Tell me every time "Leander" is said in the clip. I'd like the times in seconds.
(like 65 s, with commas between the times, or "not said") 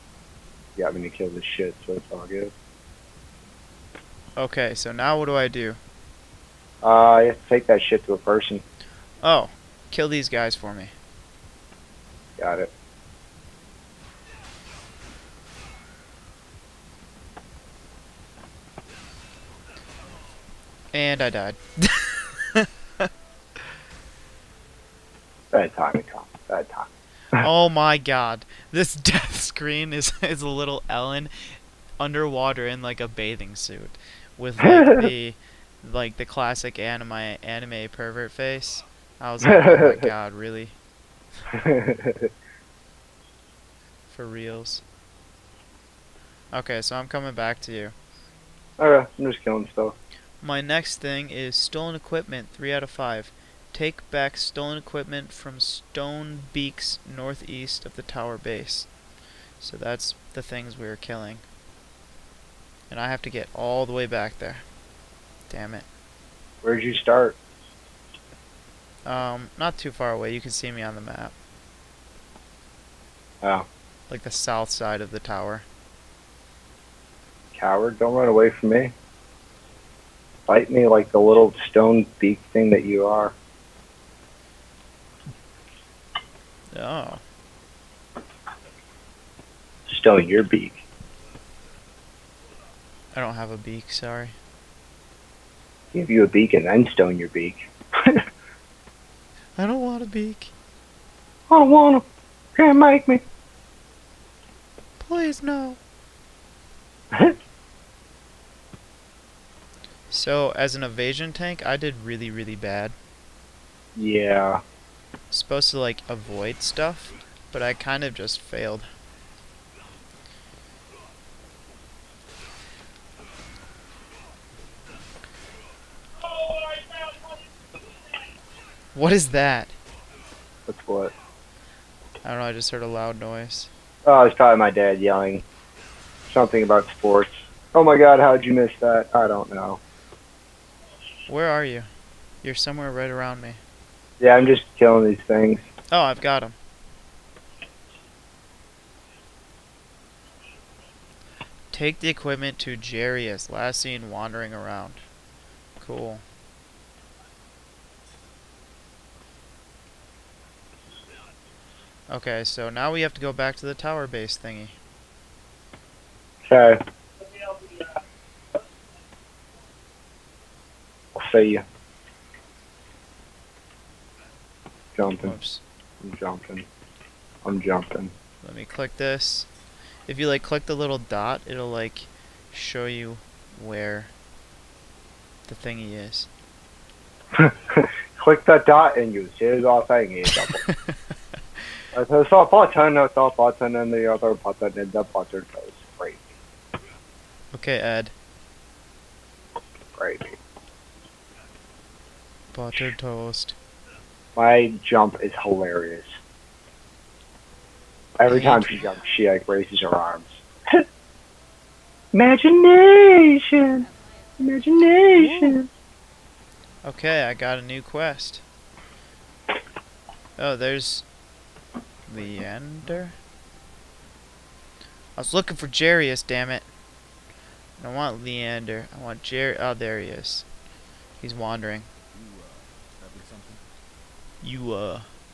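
222 s, 228 s.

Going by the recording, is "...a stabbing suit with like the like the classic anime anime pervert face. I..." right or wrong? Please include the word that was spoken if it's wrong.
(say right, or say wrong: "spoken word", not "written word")
wrong: "bathing", not "stabbing".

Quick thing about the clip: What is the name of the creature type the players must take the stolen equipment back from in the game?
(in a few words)
Stone Beaks.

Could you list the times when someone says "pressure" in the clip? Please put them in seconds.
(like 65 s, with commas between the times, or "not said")
not said.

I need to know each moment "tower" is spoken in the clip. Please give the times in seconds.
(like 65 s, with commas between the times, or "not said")
58 s, 75 s, 163 s.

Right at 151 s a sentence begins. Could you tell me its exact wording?
Take the equipment to Jerry as last seen wandering around.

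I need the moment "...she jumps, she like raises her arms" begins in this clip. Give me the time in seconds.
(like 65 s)
208 s.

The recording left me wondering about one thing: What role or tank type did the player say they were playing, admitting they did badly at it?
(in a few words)
evasion tank.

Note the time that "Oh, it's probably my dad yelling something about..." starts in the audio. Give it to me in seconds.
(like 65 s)
134 s.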